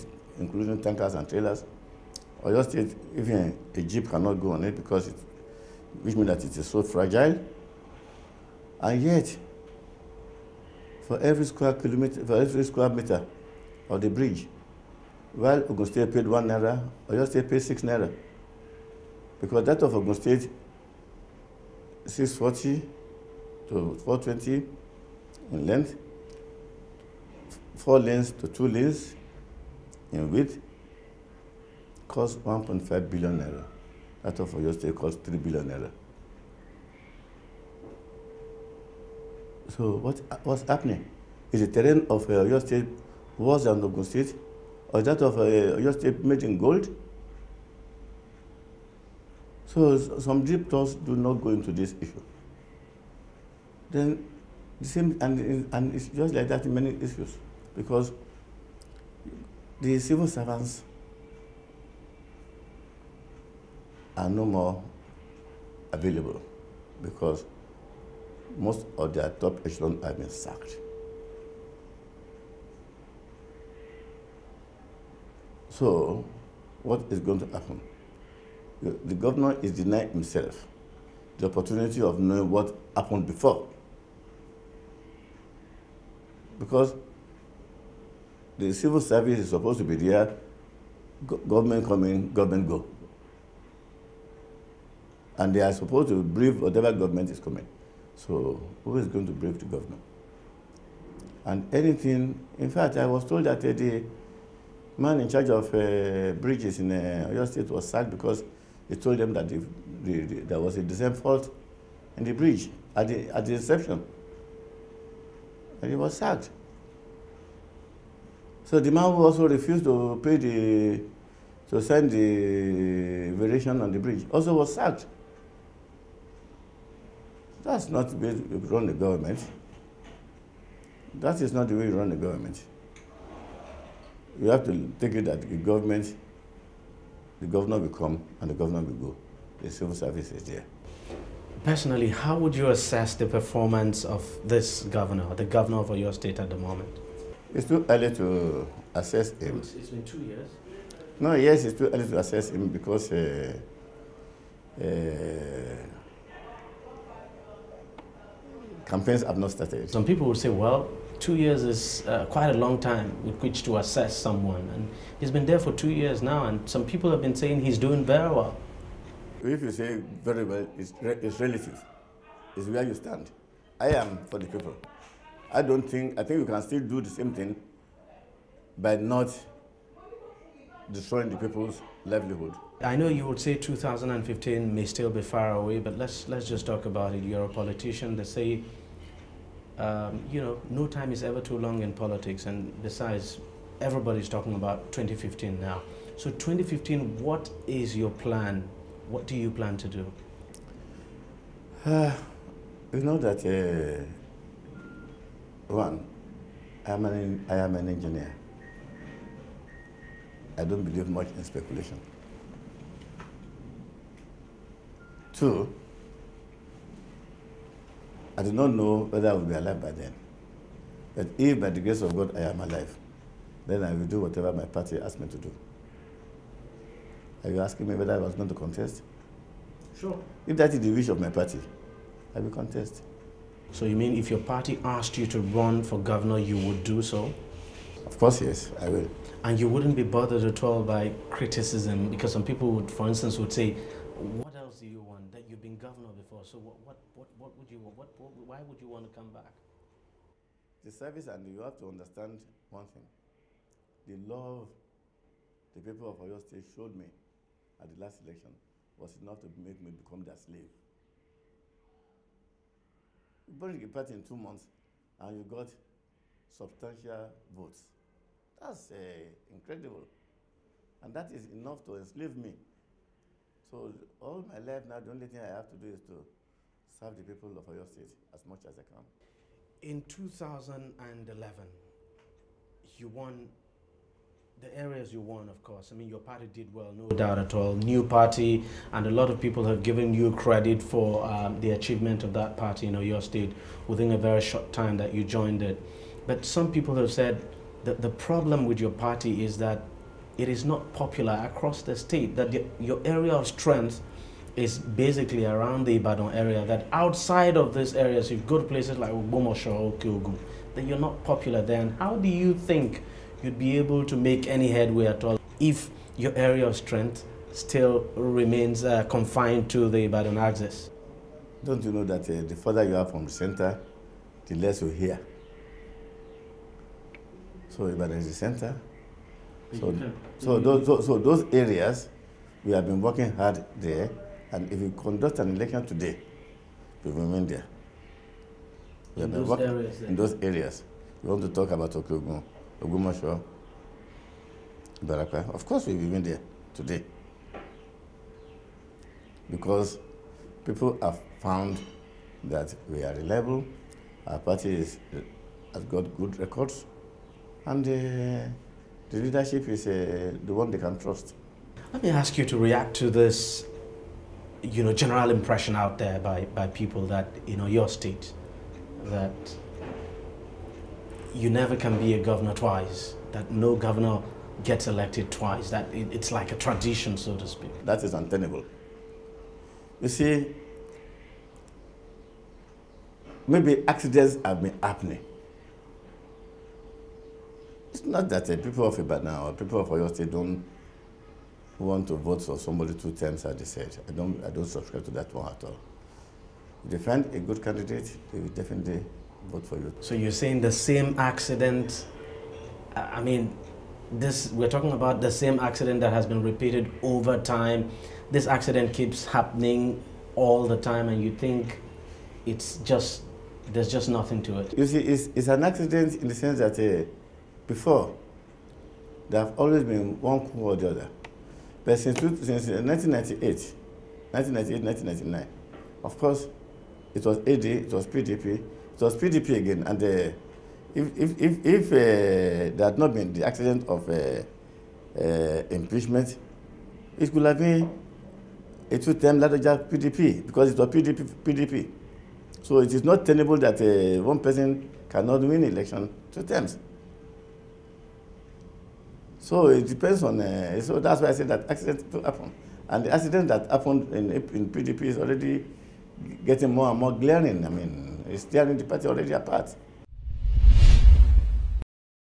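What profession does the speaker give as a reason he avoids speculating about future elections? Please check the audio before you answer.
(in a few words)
engineer.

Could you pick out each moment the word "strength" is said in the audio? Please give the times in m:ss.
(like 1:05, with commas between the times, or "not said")
5:03, 5:16.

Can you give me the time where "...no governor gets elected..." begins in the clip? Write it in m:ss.
6:13.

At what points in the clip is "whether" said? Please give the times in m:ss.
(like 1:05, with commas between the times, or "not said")
3:39, 3:47.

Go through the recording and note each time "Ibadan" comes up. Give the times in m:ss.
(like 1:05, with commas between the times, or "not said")
5:05, 5:20, 5:27, 6:28.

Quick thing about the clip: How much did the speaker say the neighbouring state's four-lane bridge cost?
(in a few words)
1.5 billion naira.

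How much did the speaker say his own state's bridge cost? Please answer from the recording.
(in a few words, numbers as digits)
3 billion naira.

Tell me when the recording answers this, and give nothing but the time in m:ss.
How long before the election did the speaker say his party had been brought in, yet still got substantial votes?
4:24.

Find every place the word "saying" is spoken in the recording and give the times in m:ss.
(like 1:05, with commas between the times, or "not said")
2:47, 6:40.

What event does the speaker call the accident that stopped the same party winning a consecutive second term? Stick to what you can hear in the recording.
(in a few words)
impeachment.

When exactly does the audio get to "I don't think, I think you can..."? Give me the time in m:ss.
2:55.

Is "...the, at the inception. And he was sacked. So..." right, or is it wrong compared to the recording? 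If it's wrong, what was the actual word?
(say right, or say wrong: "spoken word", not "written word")
right.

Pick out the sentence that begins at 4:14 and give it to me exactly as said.
The love the people of Oyo State showed me at the last election was enough to make me become their slave.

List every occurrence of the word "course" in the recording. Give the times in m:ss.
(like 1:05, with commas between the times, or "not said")
3:58, 4:45, 5:45, 7:06.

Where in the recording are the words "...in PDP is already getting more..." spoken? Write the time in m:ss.
7:34.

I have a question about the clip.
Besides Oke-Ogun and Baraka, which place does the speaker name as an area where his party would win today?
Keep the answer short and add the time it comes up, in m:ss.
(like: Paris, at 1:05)
Ogbomosho, at 5:42.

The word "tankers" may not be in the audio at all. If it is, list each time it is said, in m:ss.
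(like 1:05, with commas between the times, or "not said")
0:00.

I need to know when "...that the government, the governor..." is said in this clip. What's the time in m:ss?
2:15.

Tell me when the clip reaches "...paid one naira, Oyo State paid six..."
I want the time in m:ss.
0:16.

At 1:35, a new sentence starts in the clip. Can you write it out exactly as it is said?
And they are supposed to brief whatever government is coming.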